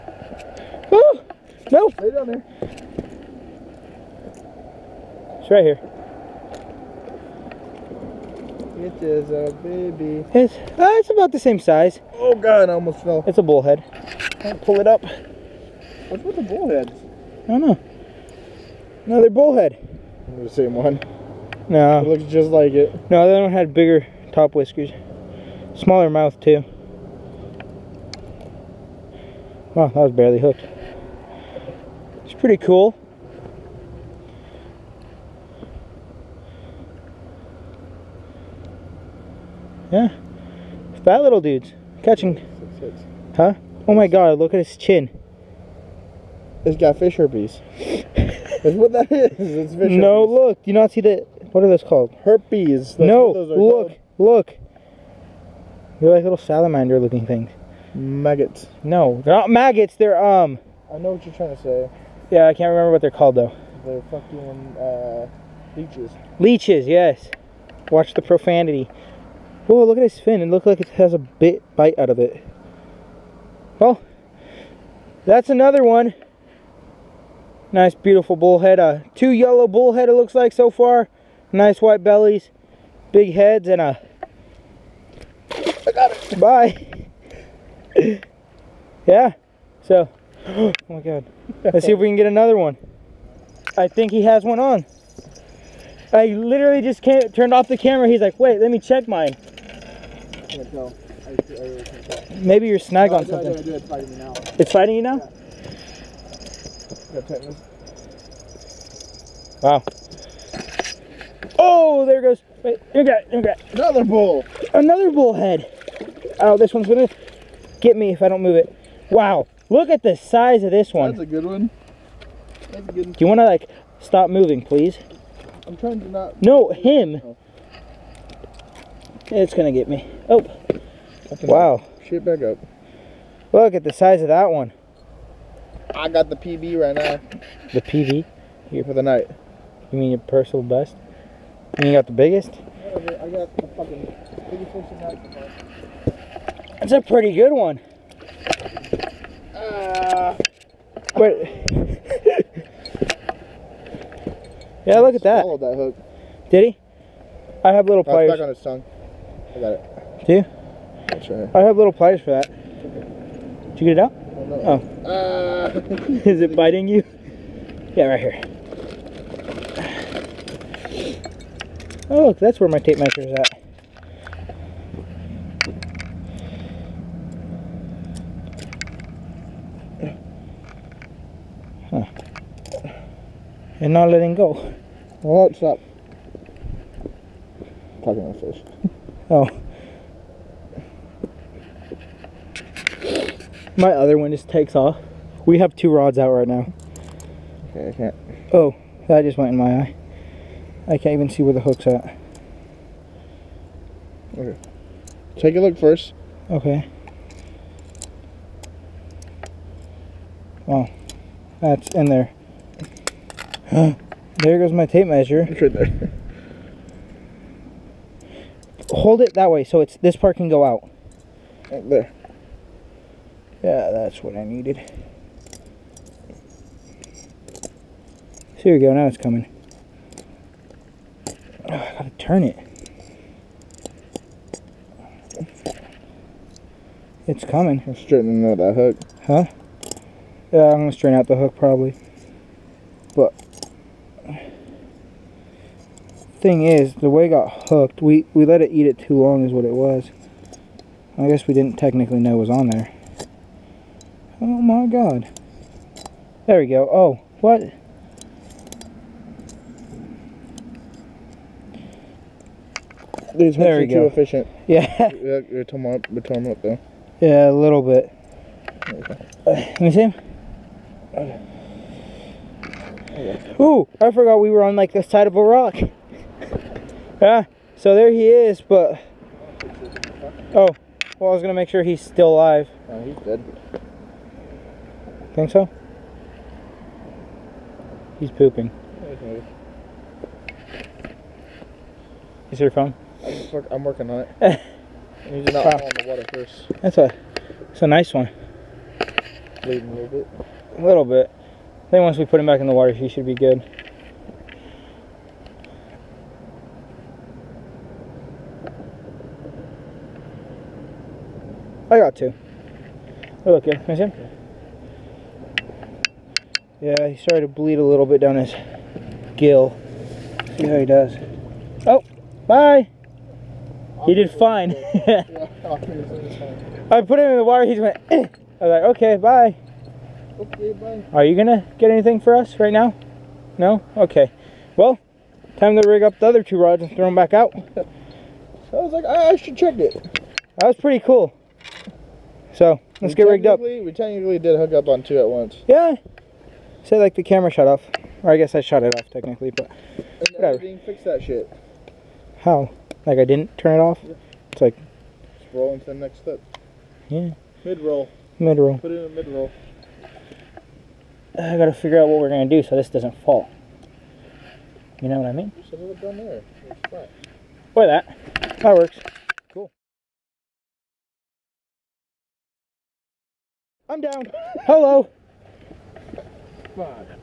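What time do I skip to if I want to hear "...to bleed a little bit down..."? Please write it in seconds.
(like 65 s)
317 s.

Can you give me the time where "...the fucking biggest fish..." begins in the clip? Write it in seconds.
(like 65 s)
143 s.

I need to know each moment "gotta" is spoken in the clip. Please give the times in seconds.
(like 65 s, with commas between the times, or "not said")
231 s, 361 s.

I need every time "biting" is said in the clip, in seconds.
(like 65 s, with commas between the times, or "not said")
166 s.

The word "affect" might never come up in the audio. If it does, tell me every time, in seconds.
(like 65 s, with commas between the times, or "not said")
not said.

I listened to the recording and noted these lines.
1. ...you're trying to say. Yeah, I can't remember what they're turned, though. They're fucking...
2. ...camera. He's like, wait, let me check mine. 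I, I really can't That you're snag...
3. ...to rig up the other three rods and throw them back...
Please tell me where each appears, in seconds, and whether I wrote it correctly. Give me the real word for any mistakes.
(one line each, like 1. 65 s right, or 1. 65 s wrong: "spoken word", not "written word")
1. 61 s wrong: "called", not "turned"
2. 97 s wrong: "Maybe", not "That"
3. 335 s wrong: "two", not "three".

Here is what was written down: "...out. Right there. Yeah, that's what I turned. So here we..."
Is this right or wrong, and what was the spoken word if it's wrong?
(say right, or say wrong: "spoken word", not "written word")
wrong: "needed", not "turned".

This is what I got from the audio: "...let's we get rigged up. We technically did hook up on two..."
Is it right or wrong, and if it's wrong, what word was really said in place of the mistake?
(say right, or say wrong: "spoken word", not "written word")
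right.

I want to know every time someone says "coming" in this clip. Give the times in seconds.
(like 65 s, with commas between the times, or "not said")
229 s, 237 s.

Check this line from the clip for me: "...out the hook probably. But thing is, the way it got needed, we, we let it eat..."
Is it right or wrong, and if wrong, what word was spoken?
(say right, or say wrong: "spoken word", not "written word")
wrong: "hooked", not "needed".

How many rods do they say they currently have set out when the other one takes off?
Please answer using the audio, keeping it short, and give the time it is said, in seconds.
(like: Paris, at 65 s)
2, at 195 s.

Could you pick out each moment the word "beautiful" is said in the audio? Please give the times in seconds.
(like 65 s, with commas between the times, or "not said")
77 s.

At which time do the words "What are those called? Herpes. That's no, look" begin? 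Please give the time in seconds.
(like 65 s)
51 s.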